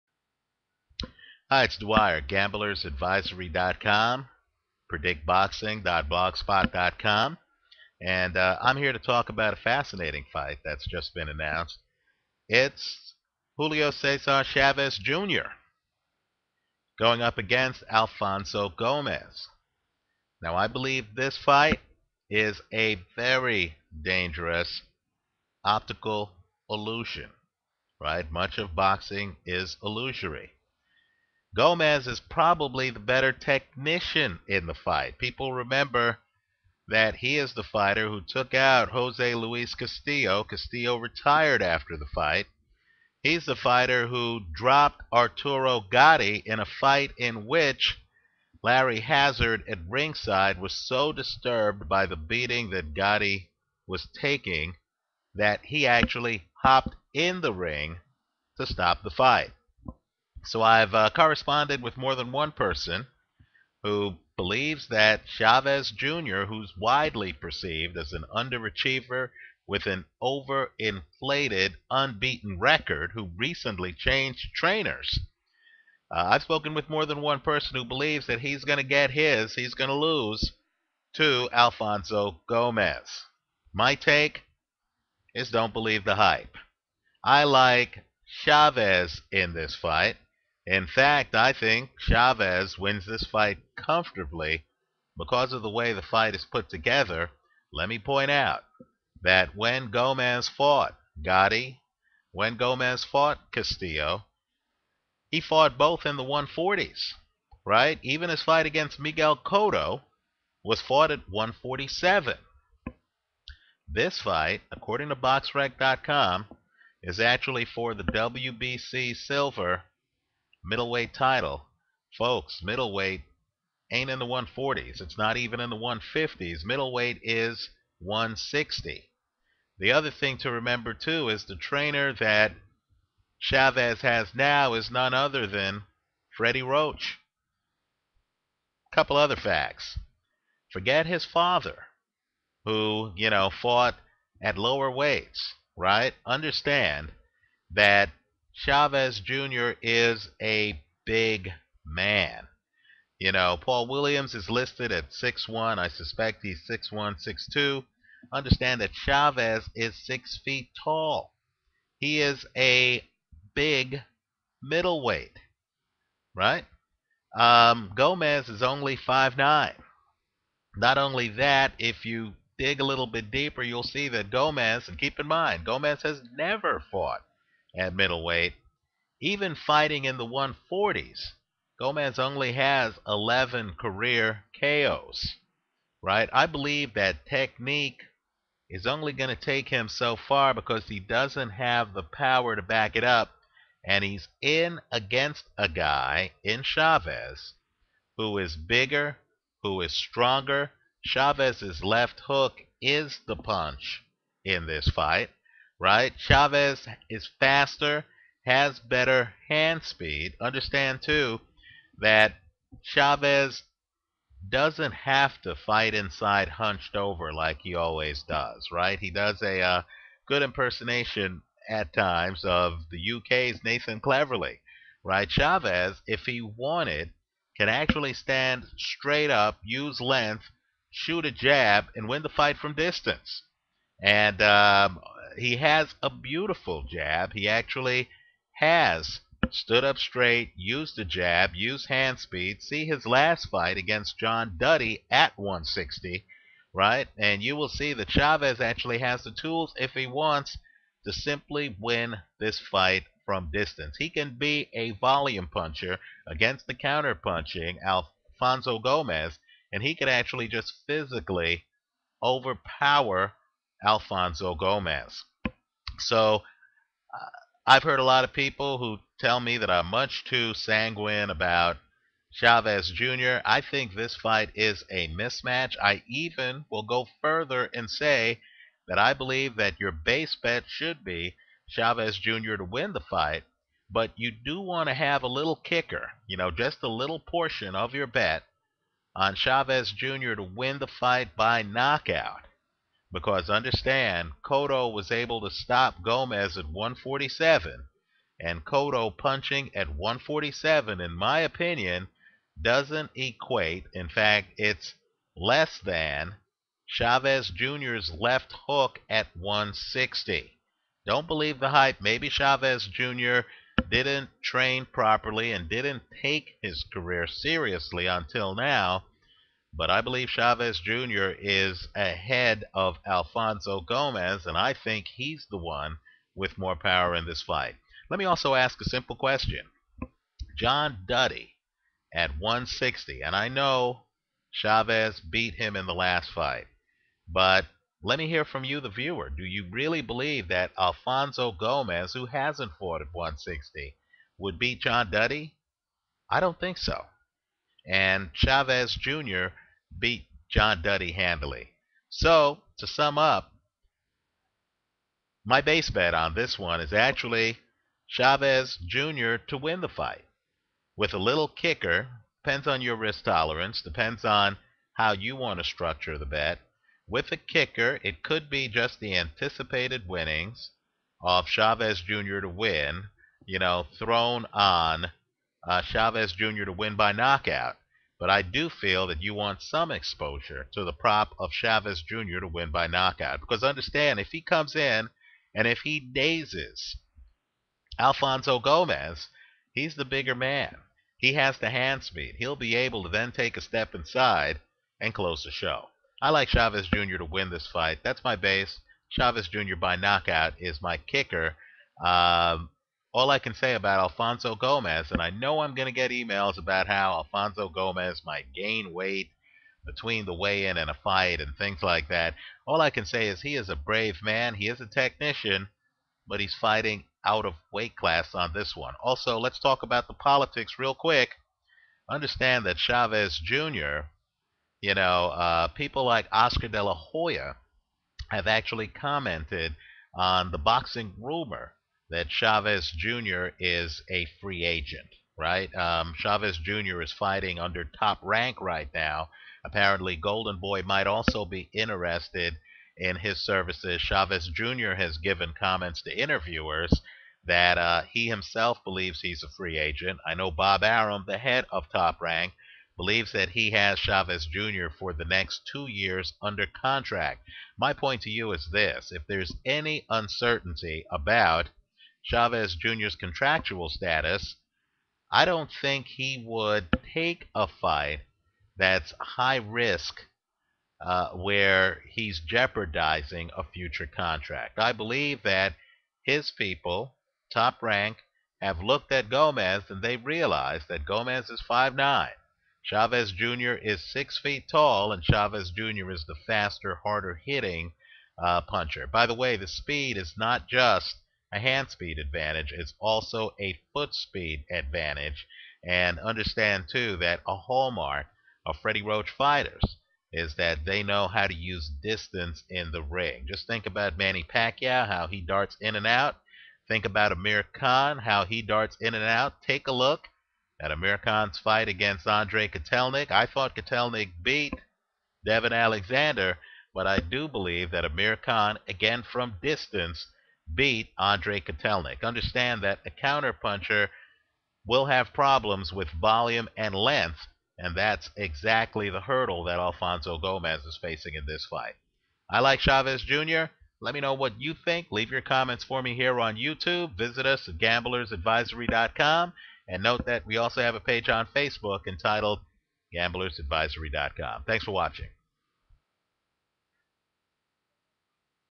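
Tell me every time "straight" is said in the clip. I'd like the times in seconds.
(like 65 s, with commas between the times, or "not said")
228 s, 239 s.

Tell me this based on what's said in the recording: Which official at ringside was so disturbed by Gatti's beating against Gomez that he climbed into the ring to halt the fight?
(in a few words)
Larry Hazzard.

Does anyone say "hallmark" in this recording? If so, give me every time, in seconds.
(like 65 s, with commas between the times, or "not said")
497 s.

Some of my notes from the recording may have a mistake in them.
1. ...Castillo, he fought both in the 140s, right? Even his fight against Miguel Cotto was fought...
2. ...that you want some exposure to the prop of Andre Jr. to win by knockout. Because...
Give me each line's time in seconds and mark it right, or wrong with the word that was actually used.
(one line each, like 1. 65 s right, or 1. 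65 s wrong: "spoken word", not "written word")
1. 103 s right
2. 379 s wrong: "Chavez", not "Andre".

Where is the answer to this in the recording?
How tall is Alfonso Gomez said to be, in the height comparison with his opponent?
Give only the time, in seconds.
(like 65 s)
168 s.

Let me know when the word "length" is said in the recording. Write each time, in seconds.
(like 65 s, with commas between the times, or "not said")
229 s, 526 s.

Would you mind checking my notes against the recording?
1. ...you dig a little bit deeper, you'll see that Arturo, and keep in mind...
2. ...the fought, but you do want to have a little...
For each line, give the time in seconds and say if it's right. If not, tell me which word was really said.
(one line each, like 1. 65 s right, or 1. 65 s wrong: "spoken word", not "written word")
1. 172 s wrong: "Gomez", not "Arturo"
2. 282 s wrong: "fight", not "fought".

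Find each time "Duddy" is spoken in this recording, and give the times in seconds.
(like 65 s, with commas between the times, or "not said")
244 s, 331 s, 345 s, 350 s.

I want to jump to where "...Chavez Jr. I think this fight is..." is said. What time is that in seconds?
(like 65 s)
272 s.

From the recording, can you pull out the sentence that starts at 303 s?
In fact, it's less than Chavez Jr.'s left hook at 160.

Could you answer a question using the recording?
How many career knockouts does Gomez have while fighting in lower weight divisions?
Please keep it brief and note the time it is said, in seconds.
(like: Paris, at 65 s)
11, at 183 s.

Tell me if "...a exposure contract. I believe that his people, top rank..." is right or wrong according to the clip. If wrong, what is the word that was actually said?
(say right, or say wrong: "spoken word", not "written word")
wrong: "future", not "exposure".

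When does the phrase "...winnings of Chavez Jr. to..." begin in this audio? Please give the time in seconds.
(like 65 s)
370 s.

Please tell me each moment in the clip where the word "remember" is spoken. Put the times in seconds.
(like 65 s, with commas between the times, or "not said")
35 s, 130 s.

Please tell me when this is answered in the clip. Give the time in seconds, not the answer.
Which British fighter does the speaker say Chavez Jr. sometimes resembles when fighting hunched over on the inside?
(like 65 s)
223 s.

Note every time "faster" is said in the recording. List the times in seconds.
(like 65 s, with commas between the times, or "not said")
207 s, 486 s.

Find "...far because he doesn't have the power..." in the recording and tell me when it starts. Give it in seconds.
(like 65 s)
190 s.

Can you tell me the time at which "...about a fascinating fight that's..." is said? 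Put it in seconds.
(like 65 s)
9 s.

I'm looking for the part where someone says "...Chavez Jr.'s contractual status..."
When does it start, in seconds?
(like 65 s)
462 s.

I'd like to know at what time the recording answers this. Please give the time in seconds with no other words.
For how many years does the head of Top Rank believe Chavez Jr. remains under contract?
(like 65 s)
455 s.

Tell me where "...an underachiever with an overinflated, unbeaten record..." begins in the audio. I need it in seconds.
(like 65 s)
68 s.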